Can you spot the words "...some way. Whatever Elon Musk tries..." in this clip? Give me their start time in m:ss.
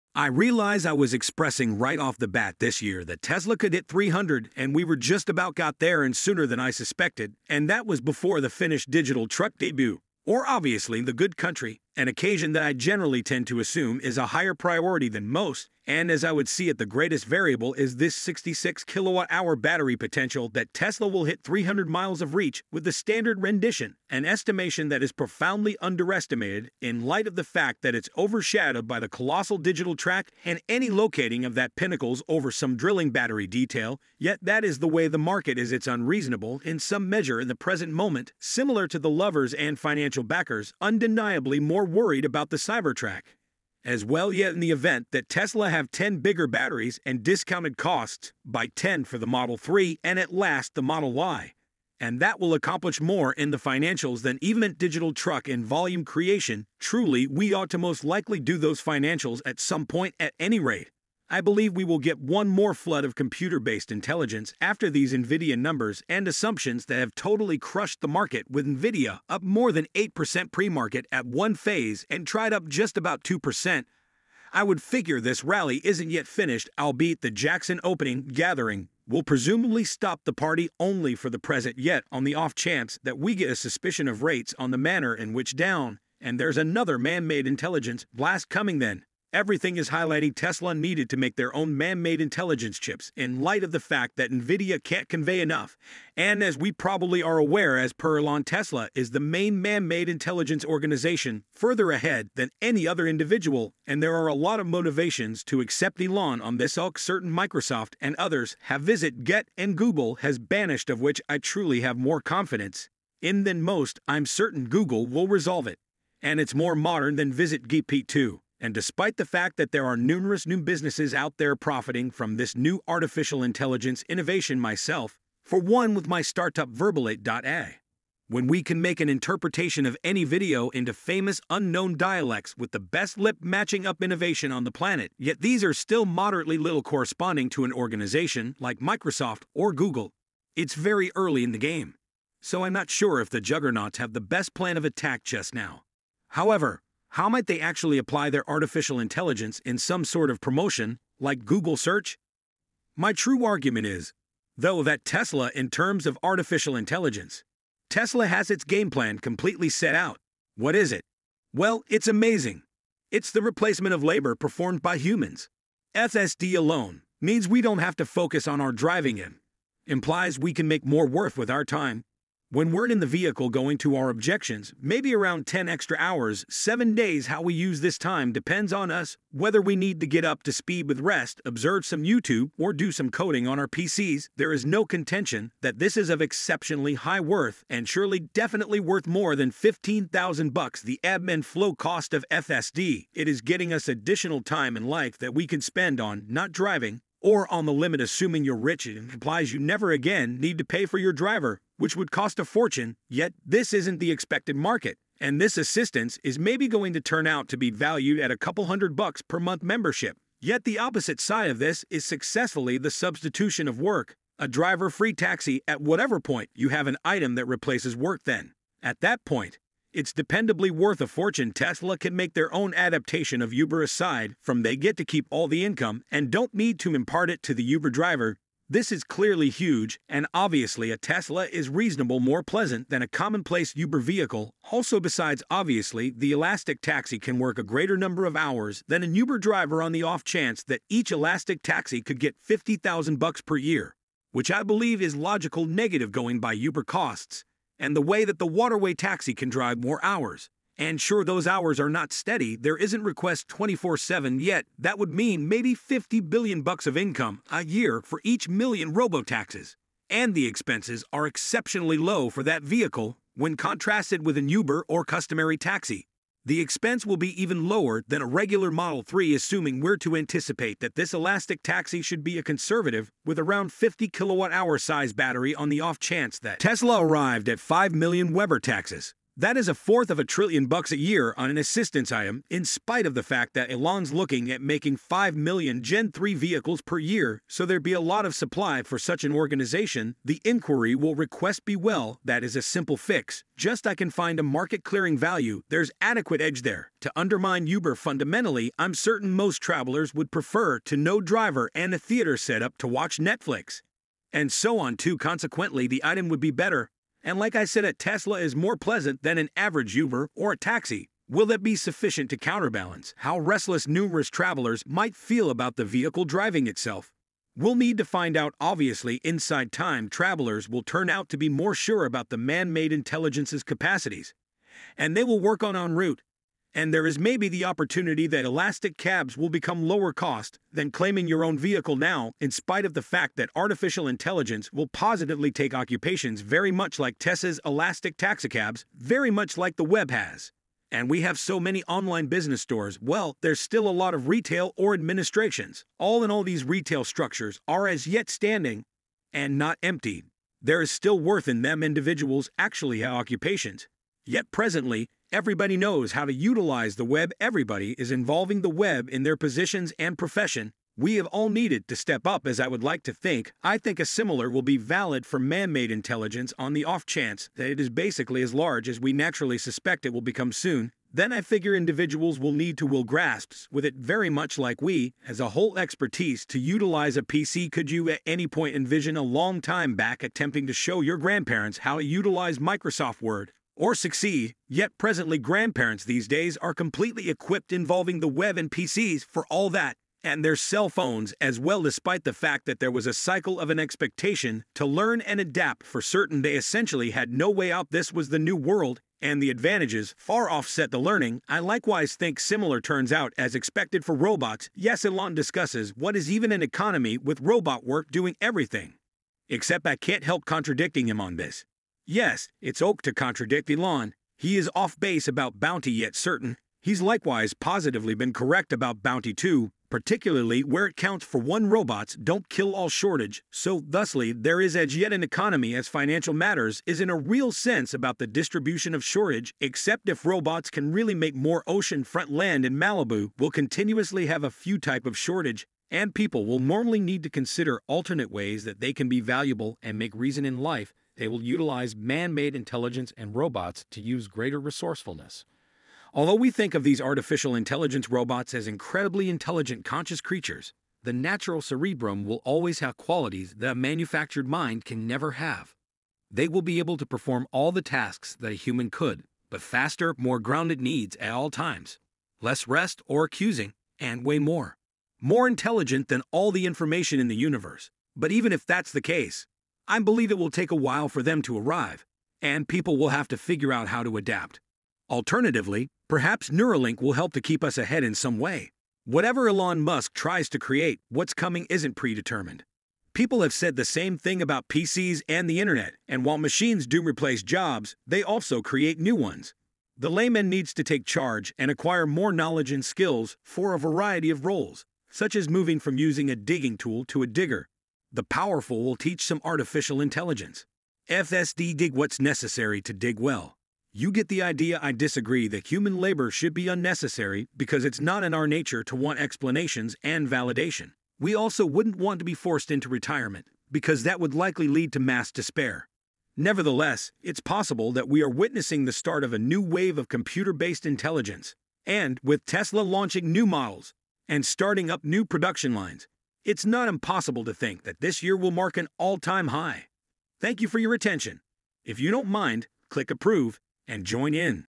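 7:58.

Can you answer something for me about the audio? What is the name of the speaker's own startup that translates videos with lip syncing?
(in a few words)
Verbalate.ai.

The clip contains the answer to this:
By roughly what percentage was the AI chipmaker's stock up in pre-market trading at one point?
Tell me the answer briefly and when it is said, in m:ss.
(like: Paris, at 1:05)
8%, at 1:09.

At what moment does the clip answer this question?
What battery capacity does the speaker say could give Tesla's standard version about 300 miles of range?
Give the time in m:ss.
0:18.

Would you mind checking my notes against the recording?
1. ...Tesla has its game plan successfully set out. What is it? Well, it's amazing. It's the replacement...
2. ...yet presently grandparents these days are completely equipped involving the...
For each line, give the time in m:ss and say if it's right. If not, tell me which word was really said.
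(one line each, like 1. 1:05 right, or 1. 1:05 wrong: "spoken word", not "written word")
1. 2:37 wrong: "completely", not "successfully"
2. 6:24 right.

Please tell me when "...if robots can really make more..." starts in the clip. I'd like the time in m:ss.
7:10.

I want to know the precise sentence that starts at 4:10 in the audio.
And sure, those hours are not steady.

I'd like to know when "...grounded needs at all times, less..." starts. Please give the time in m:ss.
7:40.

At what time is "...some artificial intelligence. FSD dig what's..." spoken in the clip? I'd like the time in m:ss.
8:19.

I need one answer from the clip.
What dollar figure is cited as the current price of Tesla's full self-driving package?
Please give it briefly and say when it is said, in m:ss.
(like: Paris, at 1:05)
$15,000, at 3:09.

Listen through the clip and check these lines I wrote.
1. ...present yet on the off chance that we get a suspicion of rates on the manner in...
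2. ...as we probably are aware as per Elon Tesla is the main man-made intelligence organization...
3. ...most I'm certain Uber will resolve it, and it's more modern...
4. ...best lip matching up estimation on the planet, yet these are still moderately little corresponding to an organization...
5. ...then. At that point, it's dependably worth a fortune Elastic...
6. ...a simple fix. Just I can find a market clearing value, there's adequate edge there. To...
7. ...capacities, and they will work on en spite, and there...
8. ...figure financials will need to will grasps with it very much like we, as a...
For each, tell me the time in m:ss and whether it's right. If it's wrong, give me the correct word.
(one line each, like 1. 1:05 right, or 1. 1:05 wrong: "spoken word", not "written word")
1. 1:21 right
2. 1:36 right
3. 1:53 wrong: "Google", not "Uber"
4. 2:12 wrong: "innovation", not "estimation"
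5. 3:38 wrong: "Tesla", not "Elastic"
6. 4:52 right
7. 5:23 wrong: "route", not "spite"
8. 6:11 wrong: "individuals", not "financials".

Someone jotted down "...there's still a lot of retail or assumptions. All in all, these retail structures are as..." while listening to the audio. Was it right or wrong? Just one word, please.
wrong.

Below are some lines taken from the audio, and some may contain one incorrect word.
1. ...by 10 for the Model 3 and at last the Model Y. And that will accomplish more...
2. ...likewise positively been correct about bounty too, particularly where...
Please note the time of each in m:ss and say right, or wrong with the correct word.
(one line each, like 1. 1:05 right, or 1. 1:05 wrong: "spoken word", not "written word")
1. 0:48 right
2. 6:57 right.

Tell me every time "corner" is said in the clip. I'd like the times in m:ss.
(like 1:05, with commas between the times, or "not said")
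not said.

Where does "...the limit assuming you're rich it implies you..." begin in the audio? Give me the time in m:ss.
3:17.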